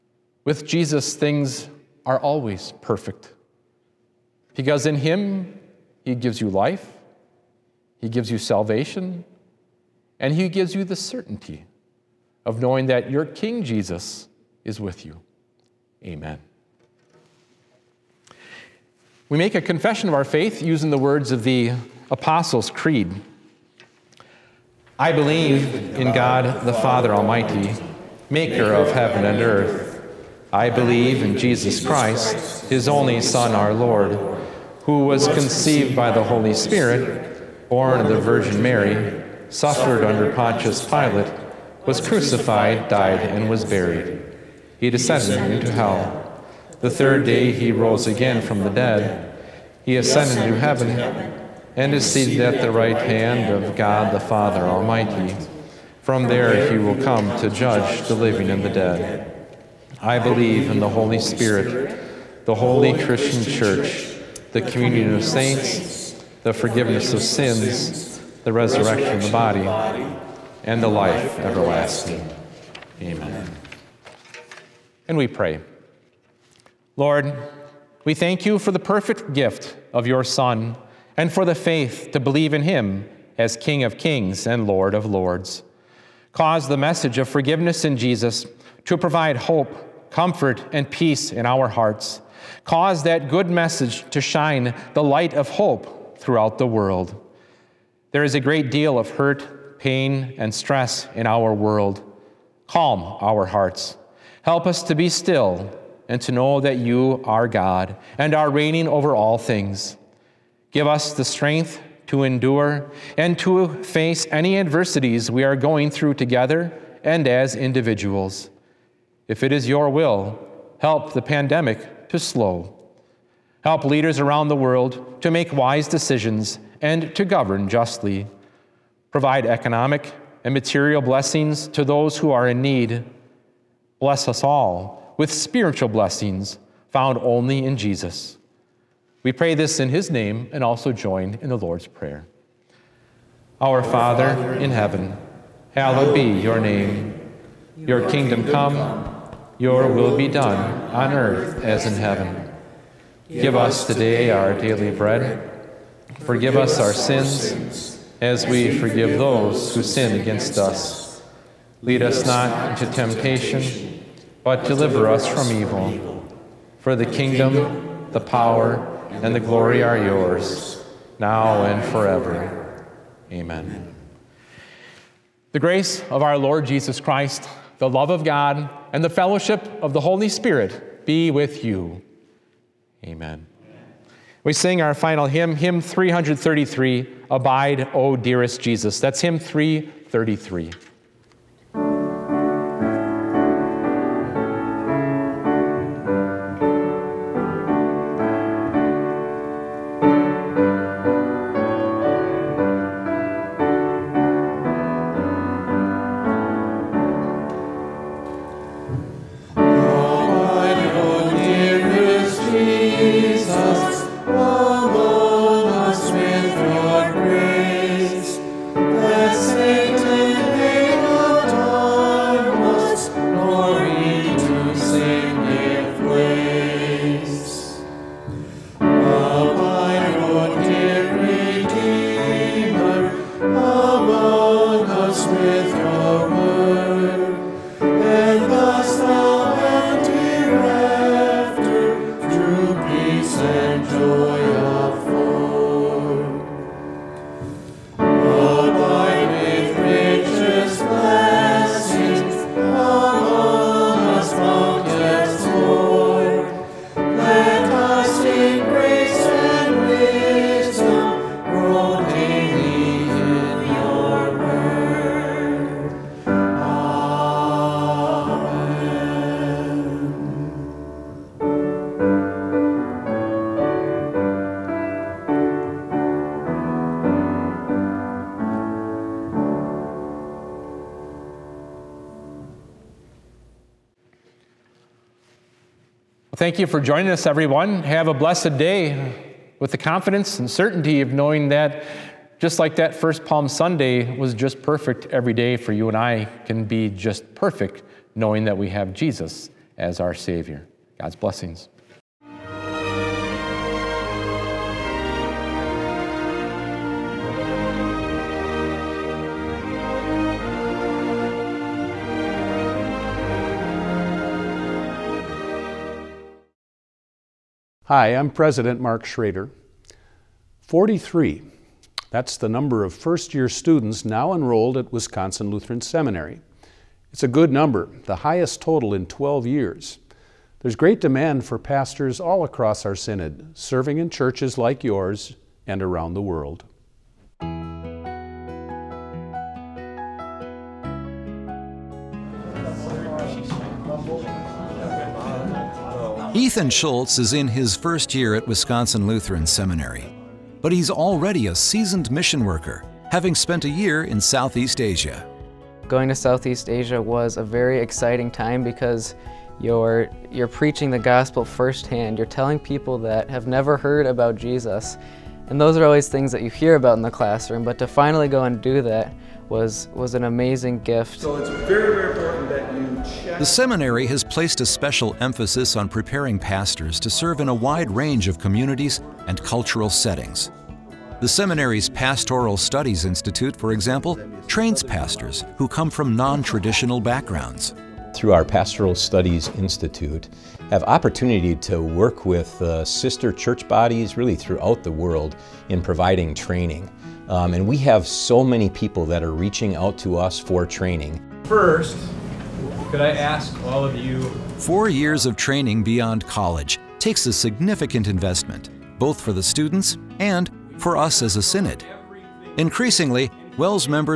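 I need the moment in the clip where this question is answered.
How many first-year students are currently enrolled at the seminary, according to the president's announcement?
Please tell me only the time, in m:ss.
5:20.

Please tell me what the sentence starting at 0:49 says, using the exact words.
He ascended to heaven and is seated at the right hand of God the Father Almighty.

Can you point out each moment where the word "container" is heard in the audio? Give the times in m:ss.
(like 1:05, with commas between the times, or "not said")
not said.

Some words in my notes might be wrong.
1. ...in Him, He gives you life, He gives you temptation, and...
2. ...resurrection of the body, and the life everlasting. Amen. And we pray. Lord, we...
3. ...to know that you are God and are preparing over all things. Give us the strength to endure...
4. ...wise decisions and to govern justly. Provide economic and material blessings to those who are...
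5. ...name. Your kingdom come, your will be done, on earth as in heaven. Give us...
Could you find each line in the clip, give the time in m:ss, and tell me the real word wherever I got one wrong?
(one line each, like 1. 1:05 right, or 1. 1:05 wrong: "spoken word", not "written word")
1. 0:04 wrong: "salvation", not "temptation"
2. 1:08 right
3. 1:46 wrong: "reigning", not "preparing"
4. 2:05 right
5. 2:26 right.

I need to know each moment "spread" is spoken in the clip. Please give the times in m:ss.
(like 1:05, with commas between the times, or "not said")
not said.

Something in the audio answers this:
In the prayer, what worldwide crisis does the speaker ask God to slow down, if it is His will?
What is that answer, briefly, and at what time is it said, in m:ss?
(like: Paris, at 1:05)
the pandemic, at 2:01.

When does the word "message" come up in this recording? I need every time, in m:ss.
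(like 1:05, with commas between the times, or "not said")
1:26, 1:33.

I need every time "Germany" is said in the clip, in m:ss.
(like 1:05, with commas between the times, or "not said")
not said.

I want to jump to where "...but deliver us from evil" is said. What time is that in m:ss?
2:44.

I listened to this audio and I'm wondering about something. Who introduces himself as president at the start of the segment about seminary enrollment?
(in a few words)
Mark Schroeder.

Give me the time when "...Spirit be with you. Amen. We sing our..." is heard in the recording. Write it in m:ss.
3:00.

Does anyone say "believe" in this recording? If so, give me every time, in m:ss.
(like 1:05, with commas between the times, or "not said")
0:25, 0:30, 1:00, 1:22.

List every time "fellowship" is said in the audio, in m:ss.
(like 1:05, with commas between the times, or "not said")
2:59.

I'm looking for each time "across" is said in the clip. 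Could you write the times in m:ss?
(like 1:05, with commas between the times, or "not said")
5:32.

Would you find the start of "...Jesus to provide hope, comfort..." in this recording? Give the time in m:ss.
1:27.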